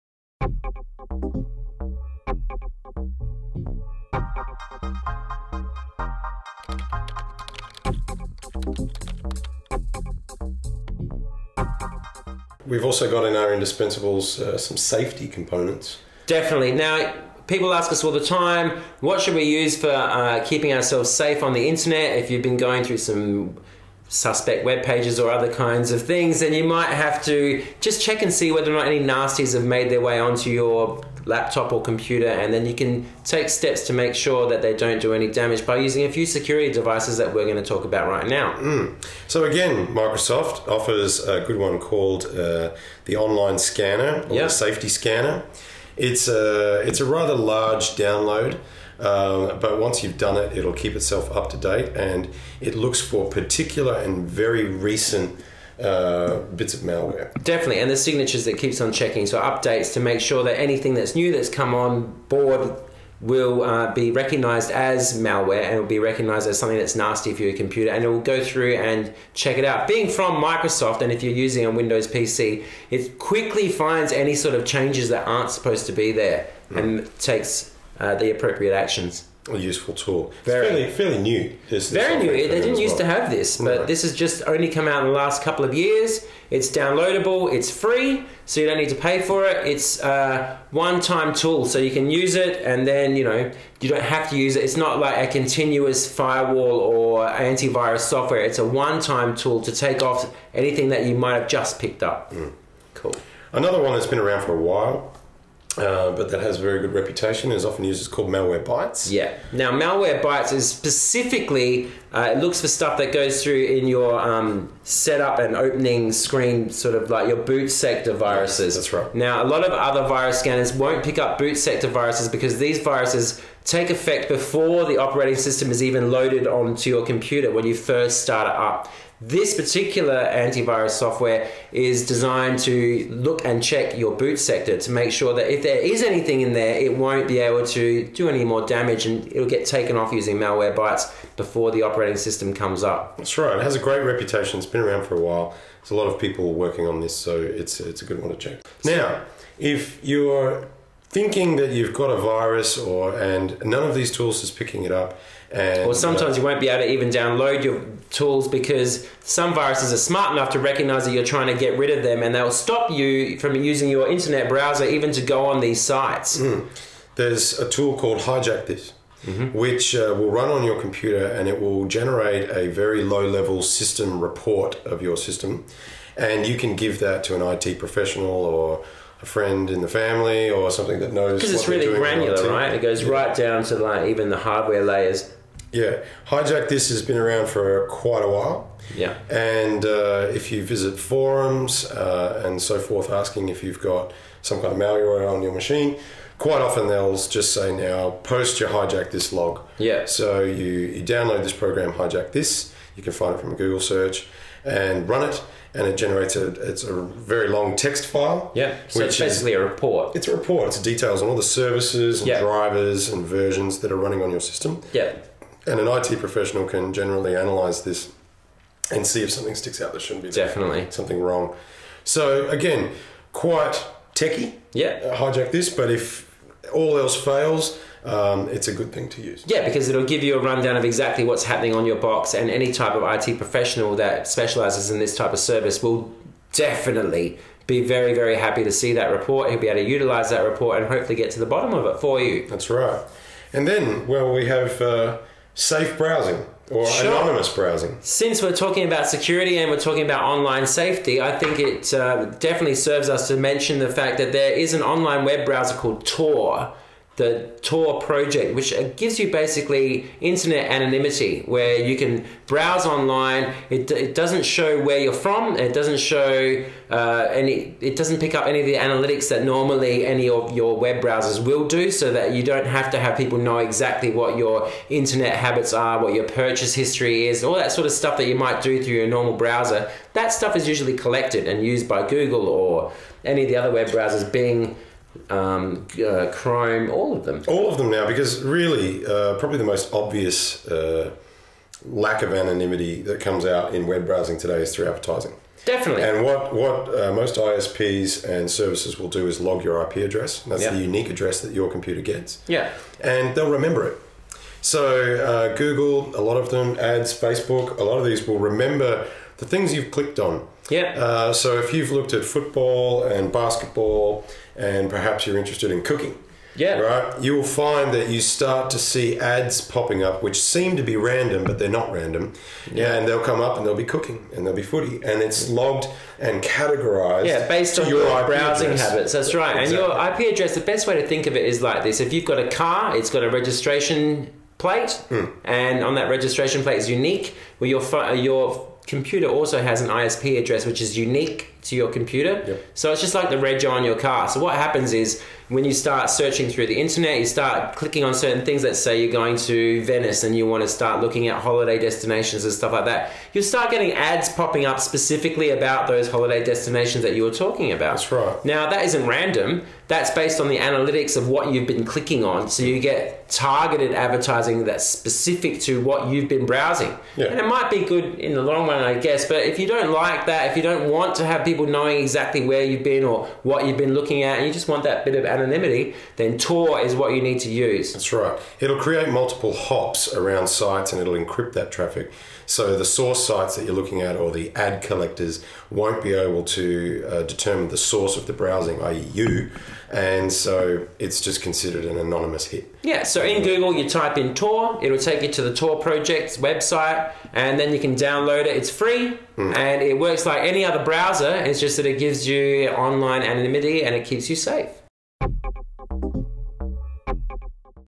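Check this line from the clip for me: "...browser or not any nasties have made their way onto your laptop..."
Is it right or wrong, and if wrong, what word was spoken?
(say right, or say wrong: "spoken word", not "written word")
wrong: "whether", not "browser".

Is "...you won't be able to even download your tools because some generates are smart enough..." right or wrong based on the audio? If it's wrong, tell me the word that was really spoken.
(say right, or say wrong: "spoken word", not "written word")
wrong: "viruses", not "generates".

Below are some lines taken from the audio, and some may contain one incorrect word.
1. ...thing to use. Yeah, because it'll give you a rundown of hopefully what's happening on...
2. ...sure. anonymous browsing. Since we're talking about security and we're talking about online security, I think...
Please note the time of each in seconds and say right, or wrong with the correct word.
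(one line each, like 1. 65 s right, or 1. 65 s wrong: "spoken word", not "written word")
1. 228 s wrong: "exactly", not "hopefully"
2. 246 s wrong: "safety", not "security".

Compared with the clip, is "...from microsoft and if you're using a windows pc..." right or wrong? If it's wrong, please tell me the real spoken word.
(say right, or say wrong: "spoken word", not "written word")
right.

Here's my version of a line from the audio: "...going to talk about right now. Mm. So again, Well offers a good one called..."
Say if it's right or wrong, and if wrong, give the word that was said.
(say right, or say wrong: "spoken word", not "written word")
wrong: "Microsoft", not "Well".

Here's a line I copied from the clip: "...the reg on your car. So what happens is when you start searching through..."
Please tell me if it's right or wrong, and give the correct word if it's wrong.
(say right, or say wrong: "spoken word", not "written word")
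right.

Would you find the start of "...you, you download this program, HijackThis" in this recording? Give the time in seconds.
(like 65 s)
200 s.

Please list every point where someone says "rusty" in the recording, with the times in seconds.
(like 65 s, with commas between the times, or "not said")
not said.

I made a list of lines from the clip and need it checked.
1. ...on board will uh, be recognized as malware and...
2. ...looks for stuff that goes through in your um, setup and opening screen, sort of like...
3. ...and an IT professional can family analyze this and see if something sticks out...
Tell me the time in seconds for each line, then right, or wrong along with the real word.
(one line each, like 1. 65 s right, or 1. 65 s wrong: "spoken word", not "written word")
1. 61 s right
2. 112 s right
3. 215 s wrong: "generally", not "family".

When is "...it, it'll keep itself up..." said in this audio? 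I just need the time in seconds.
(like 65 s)
50 s.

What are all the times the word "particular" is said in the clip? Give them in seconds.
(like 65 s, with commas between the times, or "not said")
53 s, 129 s.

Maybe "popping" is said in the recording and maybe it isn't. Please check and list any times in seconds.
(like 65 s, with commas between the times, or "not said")
319 s, 354 s.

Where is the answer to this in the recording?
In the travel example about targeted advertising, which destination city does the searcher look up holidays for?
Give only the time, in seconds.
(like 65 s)
349 s.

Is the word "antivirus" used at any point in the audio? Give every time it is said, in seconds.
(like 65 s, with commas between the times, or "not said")
97 s, 130 s.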